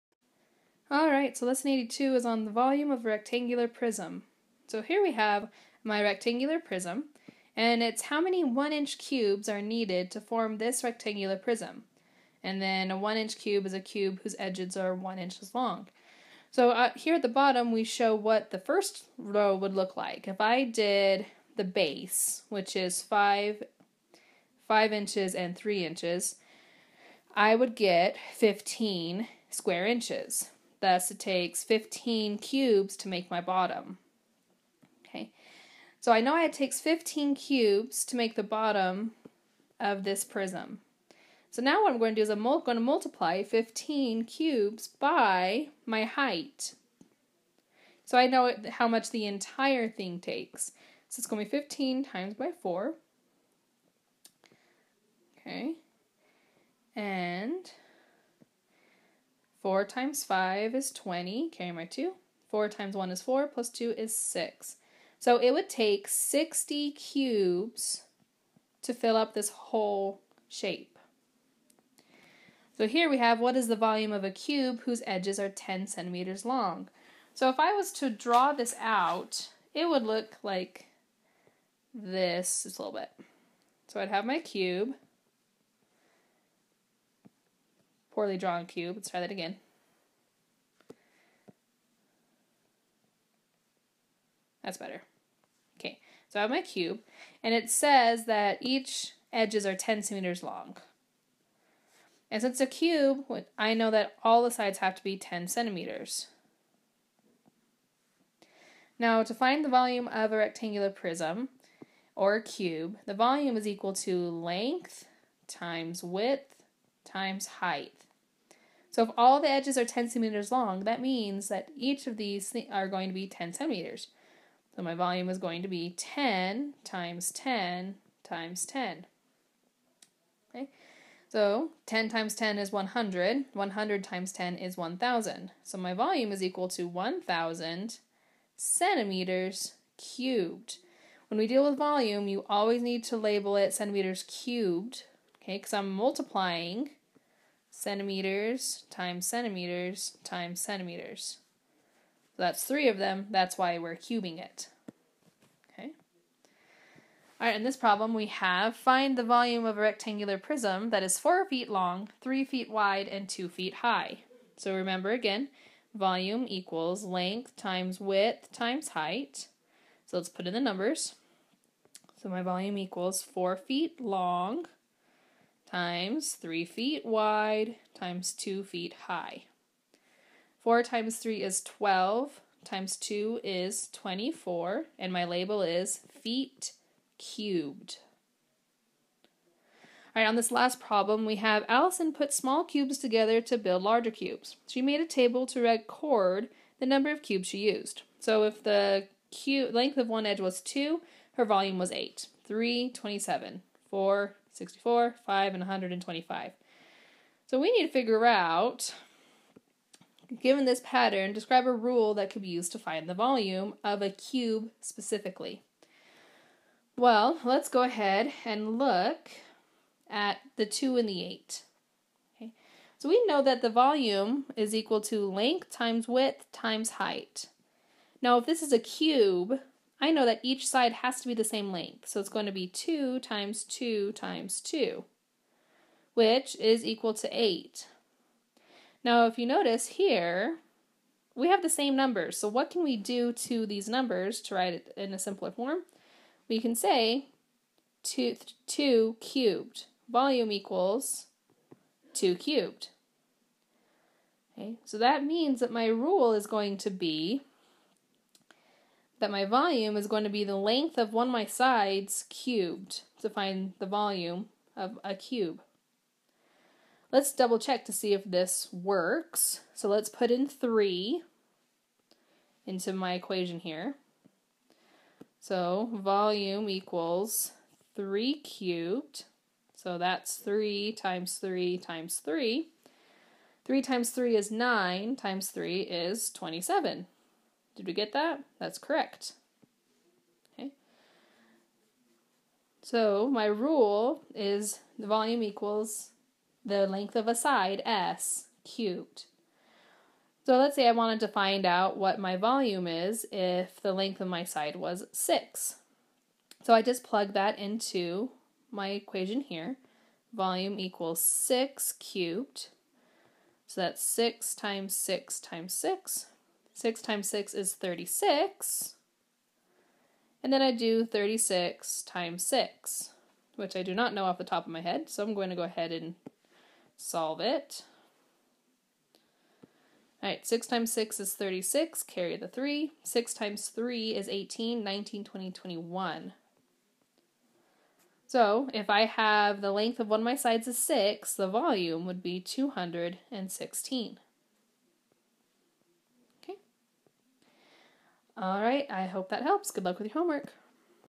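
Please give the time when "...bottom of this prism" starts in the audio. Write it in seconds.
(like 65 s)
38 s.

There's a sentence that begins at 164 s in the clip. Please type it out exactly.
So remember again, volume equals length times width times height.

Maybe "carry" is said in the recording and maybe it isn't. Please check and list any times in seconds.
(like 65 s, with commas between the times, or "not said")
61 s, 332 s.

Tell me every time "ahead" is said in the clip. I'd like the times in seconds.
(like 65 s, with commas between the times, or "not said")
217 s, 325 s.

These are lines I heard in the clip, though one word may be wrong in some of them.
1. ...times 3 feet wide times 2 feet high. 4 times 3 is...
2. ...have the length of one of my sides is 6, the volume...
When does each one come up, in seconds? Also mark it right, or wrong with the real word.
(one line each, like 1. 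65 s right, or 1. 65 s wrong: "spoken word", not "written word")
1. 175 s right
2. 339 s right.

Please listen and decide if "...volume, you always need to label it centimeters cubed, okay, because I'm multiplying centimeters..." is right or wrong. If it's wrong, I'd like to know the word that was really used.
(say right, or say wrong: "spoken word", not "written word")
right.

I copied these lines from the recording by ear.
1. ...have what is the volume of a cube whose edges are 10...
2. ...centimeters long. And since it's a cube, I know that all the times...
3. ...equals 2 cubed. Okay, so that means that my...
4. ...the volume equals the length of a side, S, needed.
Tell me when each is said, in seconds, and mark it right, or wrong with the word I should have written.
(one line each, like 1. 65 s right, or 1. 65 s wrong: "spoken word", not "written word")
1. 73 s right
2. 100 s wrong: "sides", not "times"
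3. 250 s right
4. 294 s wrong: "cubed", not "needed".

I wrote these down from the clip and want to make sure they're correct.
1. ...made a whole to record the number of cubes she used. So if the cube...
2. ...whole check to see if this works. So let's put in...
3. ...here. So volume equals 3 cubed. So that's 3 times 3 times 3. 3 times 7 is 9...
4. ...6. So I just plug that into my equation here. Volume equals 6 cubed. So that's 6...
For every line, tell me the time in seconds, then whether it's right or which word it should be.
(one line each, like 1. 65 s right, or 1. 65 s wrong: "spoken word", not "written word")
1. 194 s wrong: "table", not "whole"
2. 267 s wrong: "double", not "whole"
3. 273 s wrong: "3", not "7"
4. 305 s right.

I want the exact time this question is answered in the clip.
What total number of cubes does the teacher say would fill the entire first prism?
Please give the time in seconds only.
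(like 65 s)
66 s.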